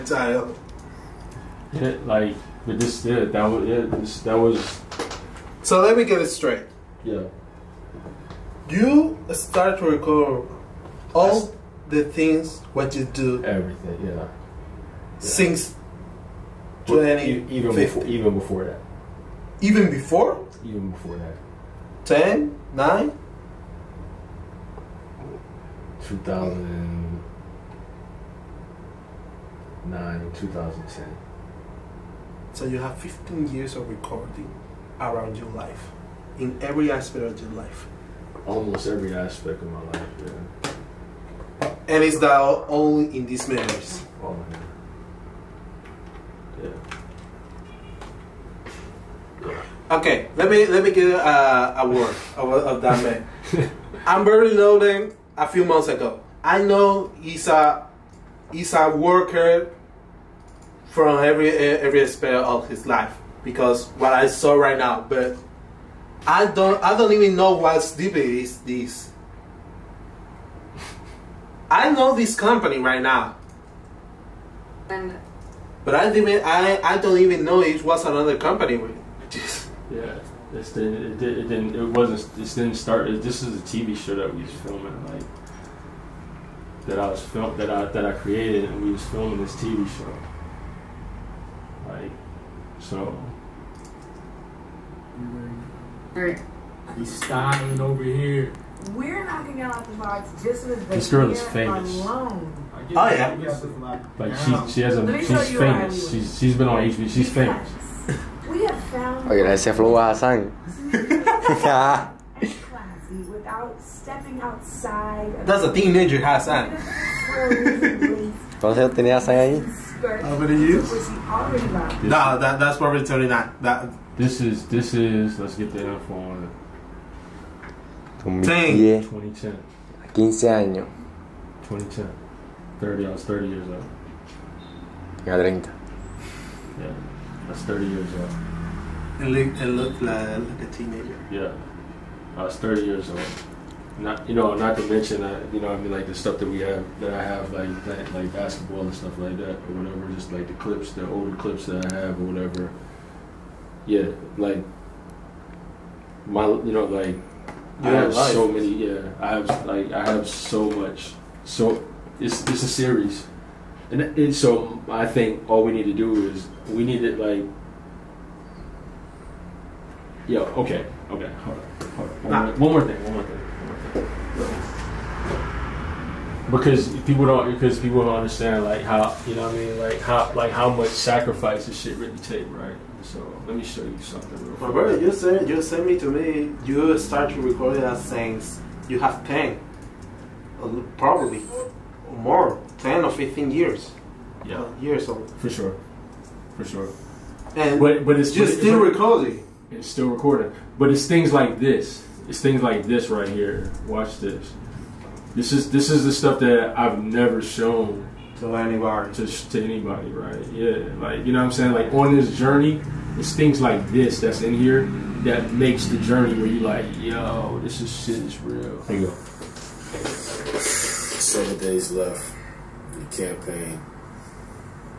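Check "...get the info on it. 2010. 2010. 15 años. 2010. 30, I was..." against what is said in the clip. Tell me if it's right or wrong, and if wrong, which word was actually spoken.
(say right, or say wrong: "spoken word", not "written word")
right.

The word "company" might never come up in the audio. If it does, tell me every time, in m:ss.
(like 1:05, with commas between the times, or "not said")
1:12, 1:18.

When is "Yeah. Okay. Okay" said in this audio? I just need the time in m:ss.
2:50.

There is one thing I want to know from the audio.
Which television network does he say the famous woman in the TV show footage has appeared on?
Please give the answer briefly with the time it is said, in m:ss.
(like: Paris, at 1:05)
HBO, at 1:46.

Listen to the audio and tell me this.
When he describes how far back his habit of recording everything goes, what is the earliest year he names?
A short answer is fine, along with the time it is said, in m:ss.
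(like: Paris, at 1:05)
2009, at 0:26.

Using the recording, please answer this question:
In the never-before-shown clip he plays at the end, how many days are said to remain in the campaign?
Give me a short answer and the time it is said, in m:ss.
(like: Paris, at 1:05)
7, at 3:40.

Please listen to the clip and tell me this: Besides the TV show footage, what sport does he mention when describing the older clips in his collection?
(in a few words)
basketball.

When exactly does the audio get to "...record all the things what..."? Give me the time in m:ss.
0:09.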